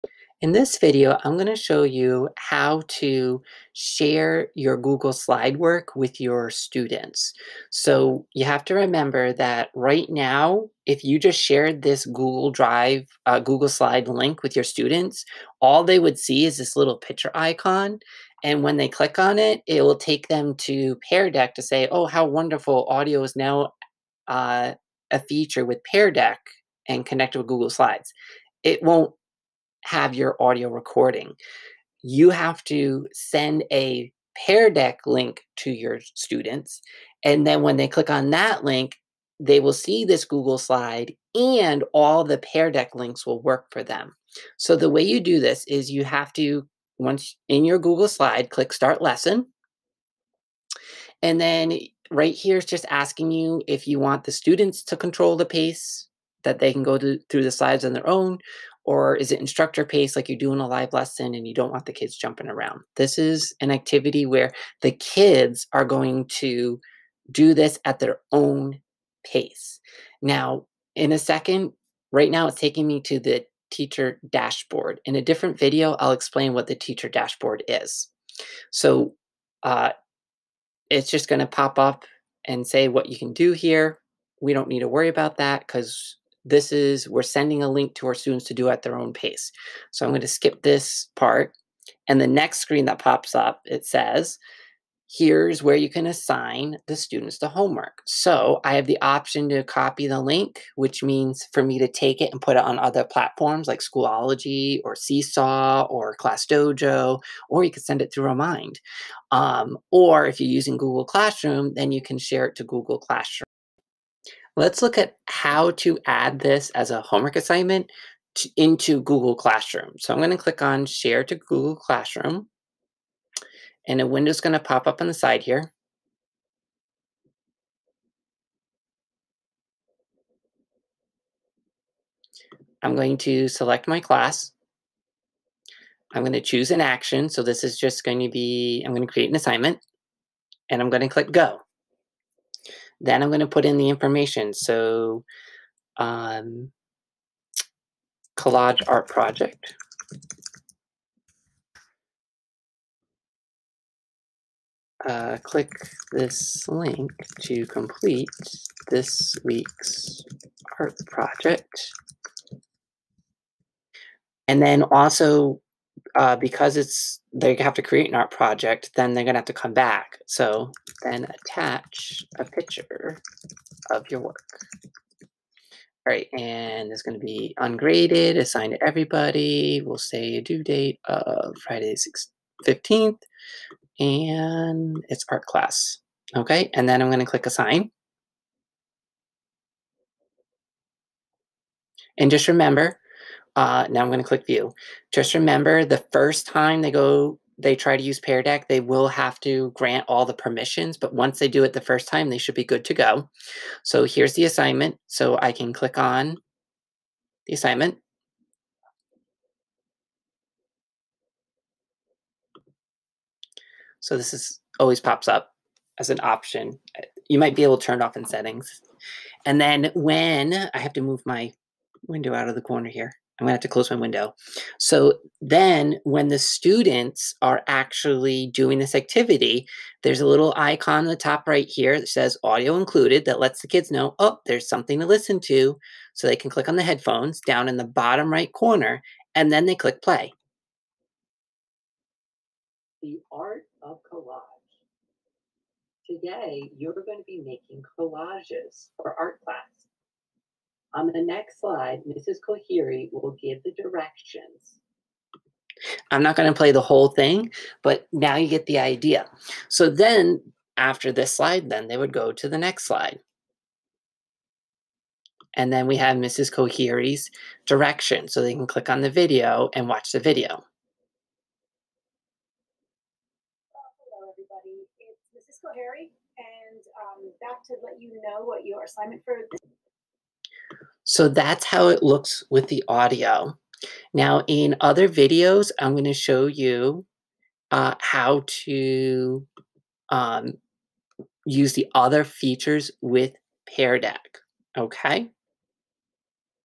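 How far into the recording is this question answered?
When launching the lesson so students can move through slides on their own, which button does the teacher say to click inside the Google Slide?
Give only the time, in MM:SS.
00:48.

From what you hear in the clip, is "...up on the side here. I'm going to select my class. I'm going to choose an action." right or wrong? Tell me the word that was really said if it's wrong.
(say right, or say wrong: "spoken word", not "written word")
right.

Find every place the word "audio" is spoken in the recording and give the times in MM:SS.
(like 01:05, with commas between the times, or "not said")
00:22, 00:30, 03:52, 04:42.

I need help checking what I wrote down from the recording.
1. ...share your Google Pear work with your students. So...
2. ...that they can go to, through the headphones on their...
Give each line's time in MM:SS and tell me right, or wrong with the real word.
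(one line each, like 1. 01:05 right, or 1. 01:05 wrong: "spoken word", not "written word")
1. 00:03 wrong: "Slide", not "Pear"
2. 00:56 wrong: "slides", not "headphones".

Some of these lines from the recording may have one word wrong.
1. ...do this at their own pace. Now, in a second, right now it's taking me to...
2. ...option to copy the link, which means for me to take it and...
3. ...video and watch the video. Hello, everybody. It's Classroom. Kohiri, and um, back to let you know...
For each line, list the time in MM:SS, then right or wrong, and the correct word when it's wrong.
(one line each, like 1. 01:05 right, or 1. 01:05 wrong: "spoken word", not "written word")
1. 01:07 right
2. 01:39 right
3. 04:29 wrong: "Mrs", not "Classroom".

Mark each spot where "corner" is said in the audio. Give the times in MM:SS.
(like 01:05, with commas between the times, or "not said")
03:42, 03:58.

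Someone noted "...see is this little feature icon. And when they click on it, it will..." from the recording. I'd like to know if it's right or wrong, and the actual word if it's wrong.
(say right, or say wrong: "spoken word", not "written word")
wrong: "picture", not "feature".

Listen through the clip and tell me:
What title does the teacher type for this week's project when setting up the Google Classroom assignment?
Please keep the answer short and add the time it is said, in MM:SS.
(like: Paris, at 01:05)
Collage art project, at 02:28.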